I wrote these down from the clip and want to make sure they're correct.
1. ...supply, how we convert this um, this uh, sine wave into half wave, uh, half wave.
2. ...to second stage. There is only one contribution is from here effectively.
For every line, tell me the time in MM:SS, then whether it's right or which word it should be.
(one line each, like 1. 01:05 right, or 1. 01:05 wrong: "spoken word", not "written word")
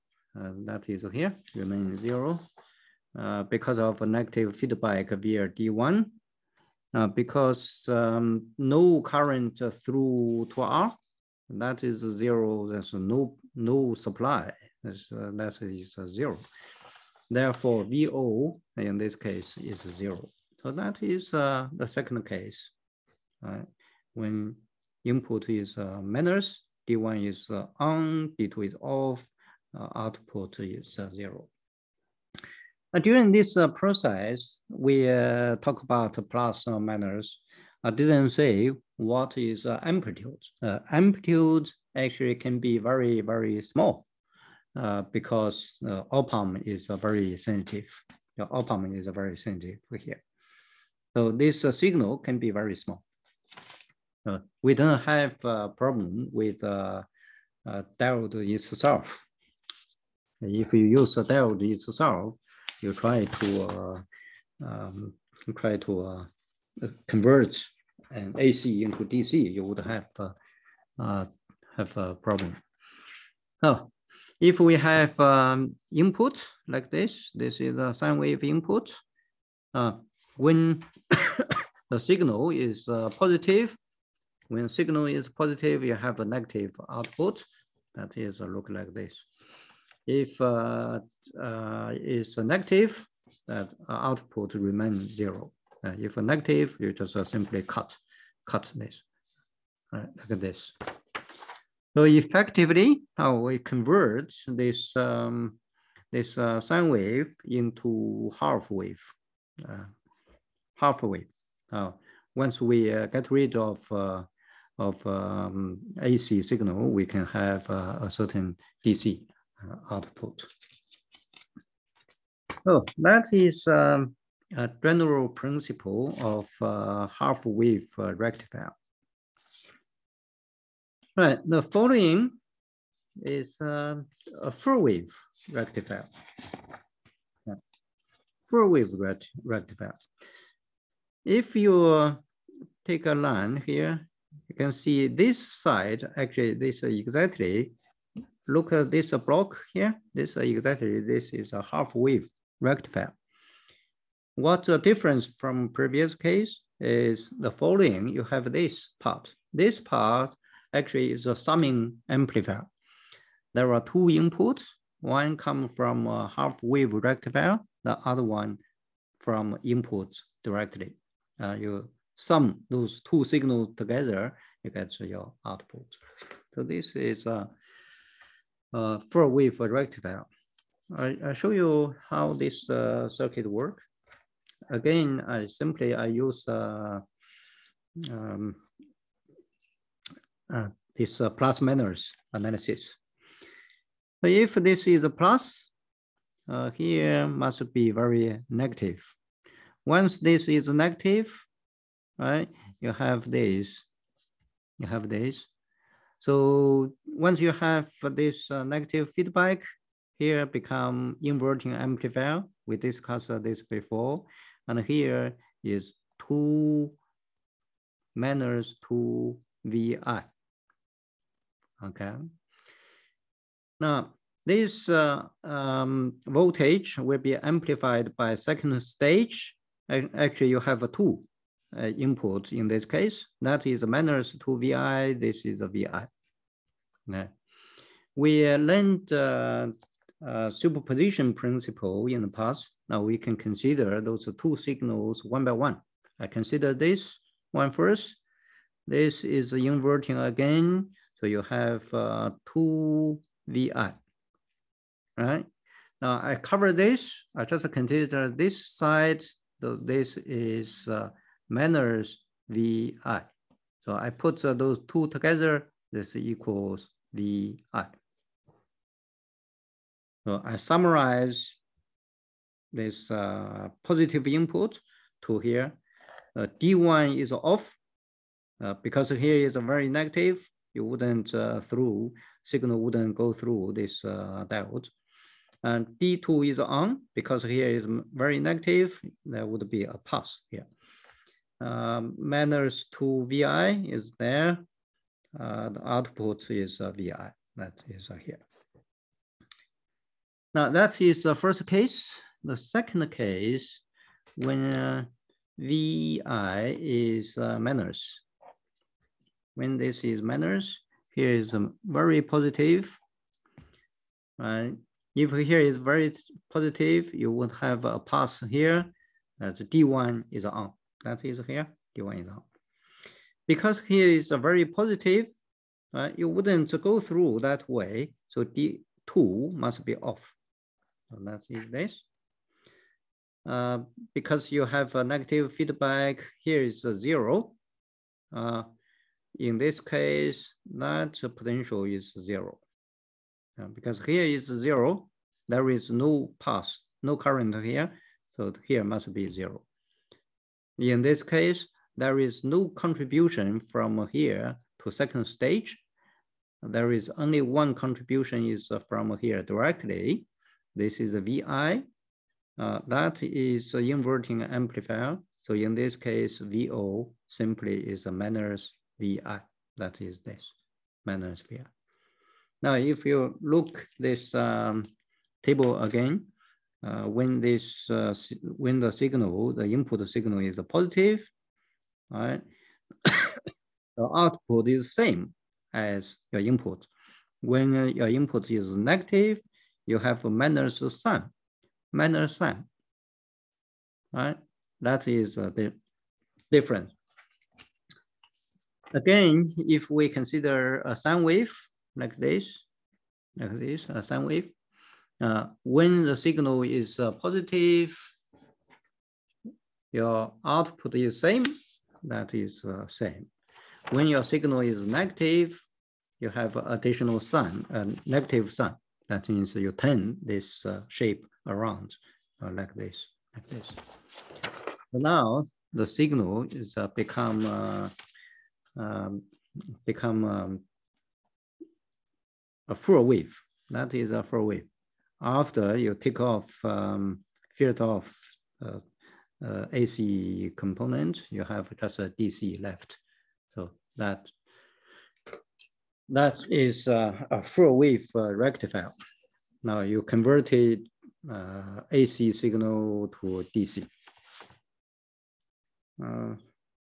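1. 01:42 wrong: "effectively", not "supply"
2. 05:54 wrong: "directly", not "effectively".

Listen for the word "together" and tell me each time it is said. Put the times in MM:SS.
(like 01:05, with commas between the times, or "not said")
02:53, 04:25.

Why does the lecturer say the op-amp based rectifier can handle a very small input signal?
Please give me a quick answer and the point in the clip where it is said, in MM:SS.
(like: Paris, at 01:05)
OPAM is very sensitive, at 00:48.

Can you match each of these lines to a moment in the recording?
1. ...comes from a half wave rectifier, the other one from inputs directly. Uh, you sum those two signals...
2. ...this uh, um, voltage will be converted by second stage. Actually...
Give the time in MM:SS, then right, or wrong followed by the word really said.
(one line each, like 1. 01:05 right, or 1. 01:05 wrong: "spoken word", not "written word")
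1. 02:45 right
2. 03:44 wrong: "amplified", not "converted".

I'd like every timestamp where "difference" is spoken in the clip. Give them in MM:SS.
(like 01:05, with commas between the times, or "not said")
02:34, 06:36.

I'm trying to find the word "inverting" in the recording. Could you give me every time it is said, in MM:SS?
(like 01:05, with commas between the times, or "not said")
03:31, 04:09, 06:03.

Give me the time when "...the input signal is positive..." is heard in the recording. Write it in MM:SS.
06:19.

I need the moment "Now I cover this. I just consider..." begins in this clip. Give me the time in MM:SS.
04:16.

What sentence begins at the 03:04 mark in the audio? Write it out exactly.
Again, I simply I use uh, um, uh, this uh, plus minus analysis.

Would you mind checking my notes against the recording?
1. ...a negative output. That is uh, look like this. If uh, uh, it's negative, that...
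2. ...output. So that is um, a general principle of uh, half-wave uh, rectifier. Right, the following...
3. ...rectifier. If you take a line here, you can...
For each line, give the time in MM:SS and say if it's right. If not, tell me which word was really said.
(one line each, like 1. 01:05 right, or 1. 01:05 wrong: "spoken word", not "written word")
1. 01:26 right
2. 01:59 right
3. 02:19 right.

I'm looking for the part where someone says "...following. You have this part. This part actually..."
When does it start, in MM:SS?
02:37.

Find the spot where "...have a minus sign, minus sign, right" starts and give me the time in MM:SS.
06:29.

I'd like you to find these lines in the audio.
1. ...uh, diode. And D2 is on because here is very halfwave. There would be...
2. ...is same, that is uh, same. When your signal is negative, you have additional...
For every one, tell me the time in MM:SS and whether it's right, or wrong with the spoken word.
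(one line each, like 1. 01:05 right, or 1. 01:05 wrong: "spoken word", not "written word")
1. 04:44 wrong: "negative", not "halfwave"
2. 06:50 right.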